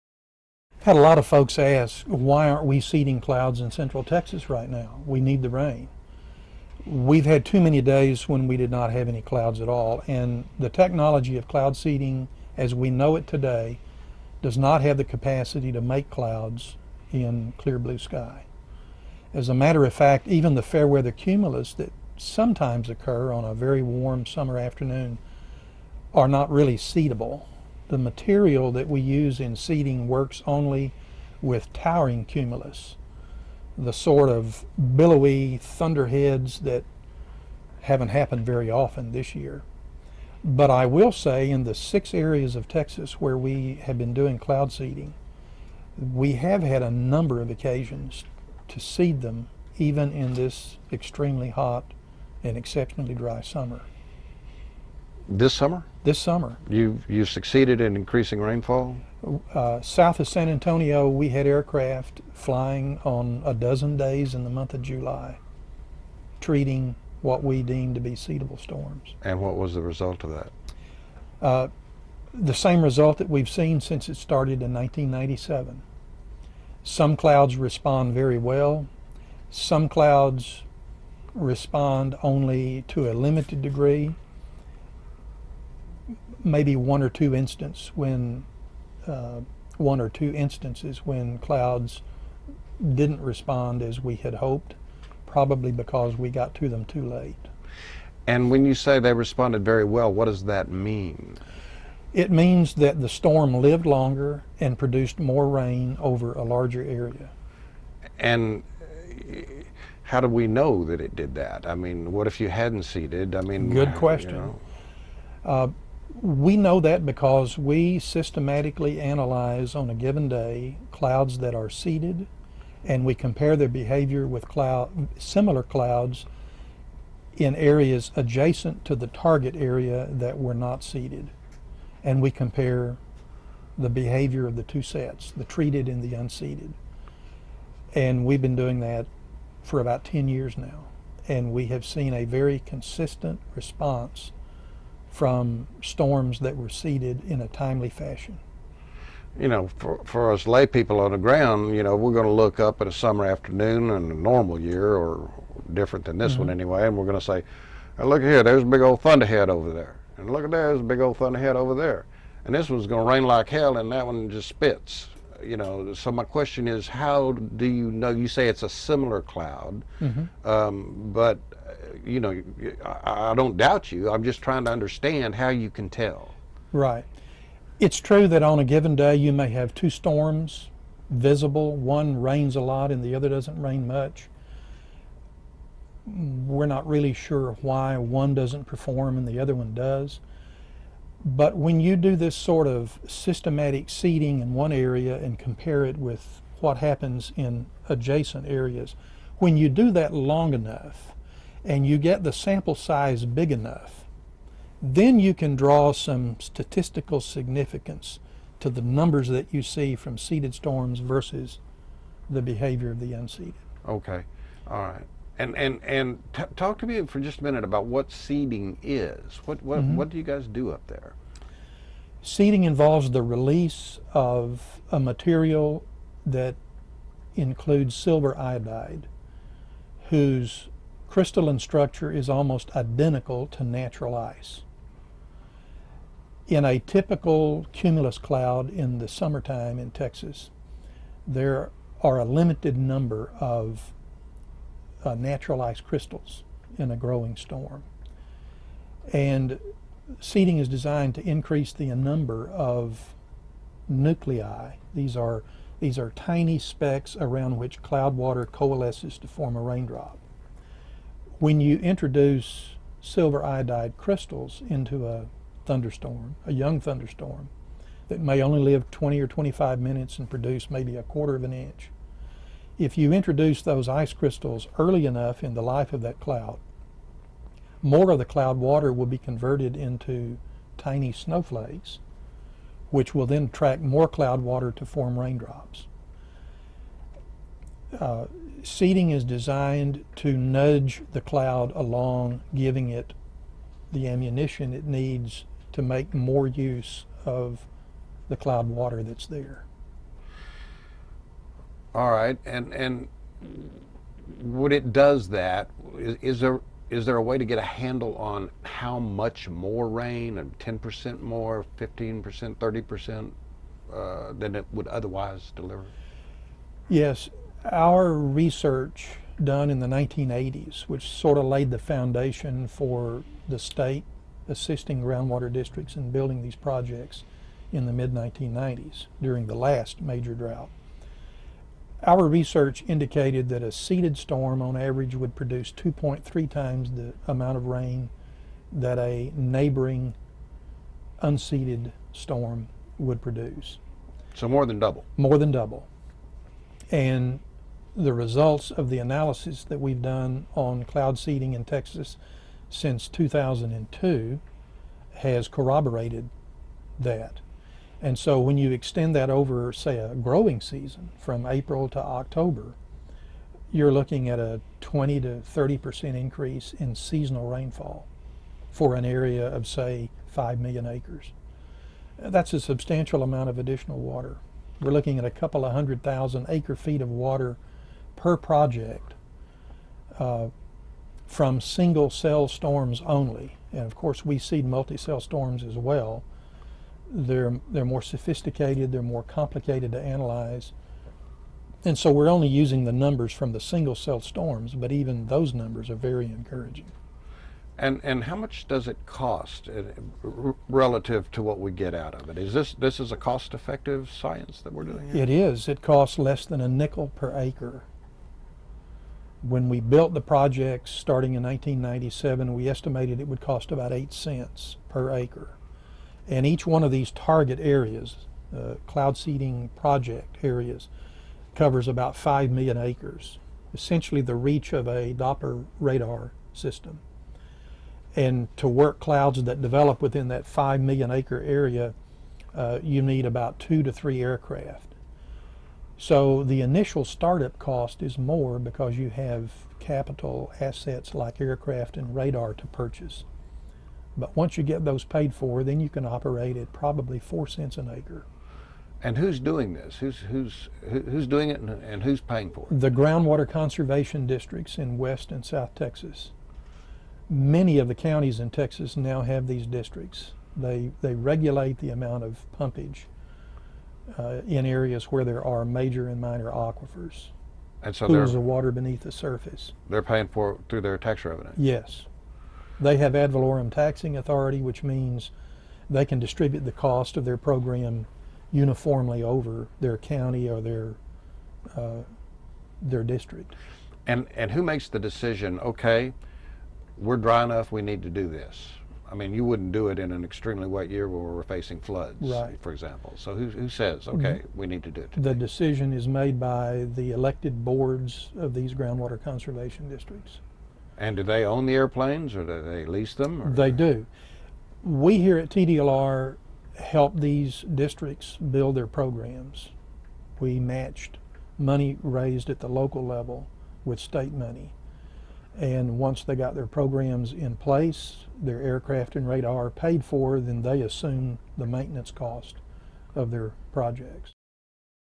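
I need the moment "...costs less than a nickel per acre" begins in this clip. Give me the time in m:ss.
6:45.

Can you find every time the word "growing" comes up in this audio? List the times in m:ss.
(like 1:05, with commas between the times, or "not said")
4:06, 6:00.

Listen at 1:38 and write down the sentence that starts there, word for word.
And when you say they responded very well, what does that mean?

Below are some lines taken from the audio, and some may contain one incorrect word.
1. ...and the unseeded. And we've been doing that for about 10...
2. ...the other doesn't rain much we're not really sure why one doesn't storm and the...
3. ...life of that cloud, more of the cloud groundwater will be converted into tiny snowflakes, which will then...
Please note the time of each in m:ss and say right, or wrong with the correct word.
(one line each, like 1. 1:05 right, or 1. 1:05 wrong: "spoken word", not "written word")
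1. 2:15 right
2. 3:03 wrong: "perform", not "storm"
3. 4:35 wrong: "water", not "groundwater".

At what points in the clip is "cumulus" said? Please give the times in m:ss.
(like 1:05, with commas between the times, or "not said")
0:21, 0:32, 3:57.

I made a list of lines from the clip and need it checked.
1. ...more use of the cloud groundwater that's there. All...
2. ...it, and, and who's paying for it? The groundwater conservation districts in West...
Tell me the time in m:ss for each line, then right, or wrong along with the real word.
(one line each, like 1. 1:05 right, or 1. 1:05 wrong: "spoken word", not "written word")
1. 4:56 wrong: "water", not "groundwater"
2. 7:31 right.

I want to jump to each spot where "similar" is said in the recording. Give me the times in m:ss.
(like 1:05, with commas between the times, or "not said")
2:05, 2:48.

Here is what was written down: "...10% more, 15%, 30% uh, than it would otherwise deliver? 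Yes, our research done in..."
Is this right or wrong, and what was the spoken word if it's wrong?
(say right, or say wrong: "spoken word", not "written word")
right.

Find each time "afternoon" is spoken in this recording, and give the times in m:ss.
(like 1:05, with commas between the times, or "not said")
0:24, 2:33.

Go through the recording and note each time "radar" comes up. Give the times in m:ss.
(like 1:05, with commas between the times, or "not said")
7:05, 7:22, 8:39.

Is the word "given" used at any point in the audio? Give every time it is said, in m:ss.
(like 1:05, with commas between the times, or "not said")
1:59, 2:58.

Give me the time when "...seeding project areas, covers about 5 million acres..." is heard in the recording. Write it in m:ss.
6:59.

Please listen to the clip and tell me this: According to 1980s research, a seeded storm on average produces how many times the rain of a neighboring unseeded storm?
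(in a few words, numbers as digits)
2.3 times.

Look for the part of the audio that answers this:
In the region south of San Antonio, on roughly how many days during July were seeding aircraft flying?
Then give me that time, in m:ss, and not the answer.
1:03.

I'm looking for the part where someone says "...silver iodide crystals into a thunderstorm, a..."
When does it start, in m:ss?
4:23.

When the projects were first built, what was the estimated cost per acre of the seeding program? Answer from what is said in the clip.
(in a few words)
8 cents.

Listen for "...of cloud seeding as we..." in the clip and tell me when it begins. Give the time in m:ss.
0:11.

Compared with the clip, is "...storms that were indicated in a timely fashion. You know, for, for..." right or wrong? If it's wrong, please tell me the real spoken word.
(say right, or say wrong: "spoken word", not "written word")
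wrong: "seeded", not "indicated".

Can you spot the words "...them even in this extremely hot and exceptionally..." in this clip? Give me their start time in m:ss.
0:49.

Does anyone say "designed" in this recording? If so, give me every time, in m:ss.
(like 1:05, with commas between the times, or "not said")
4:10, 4:49.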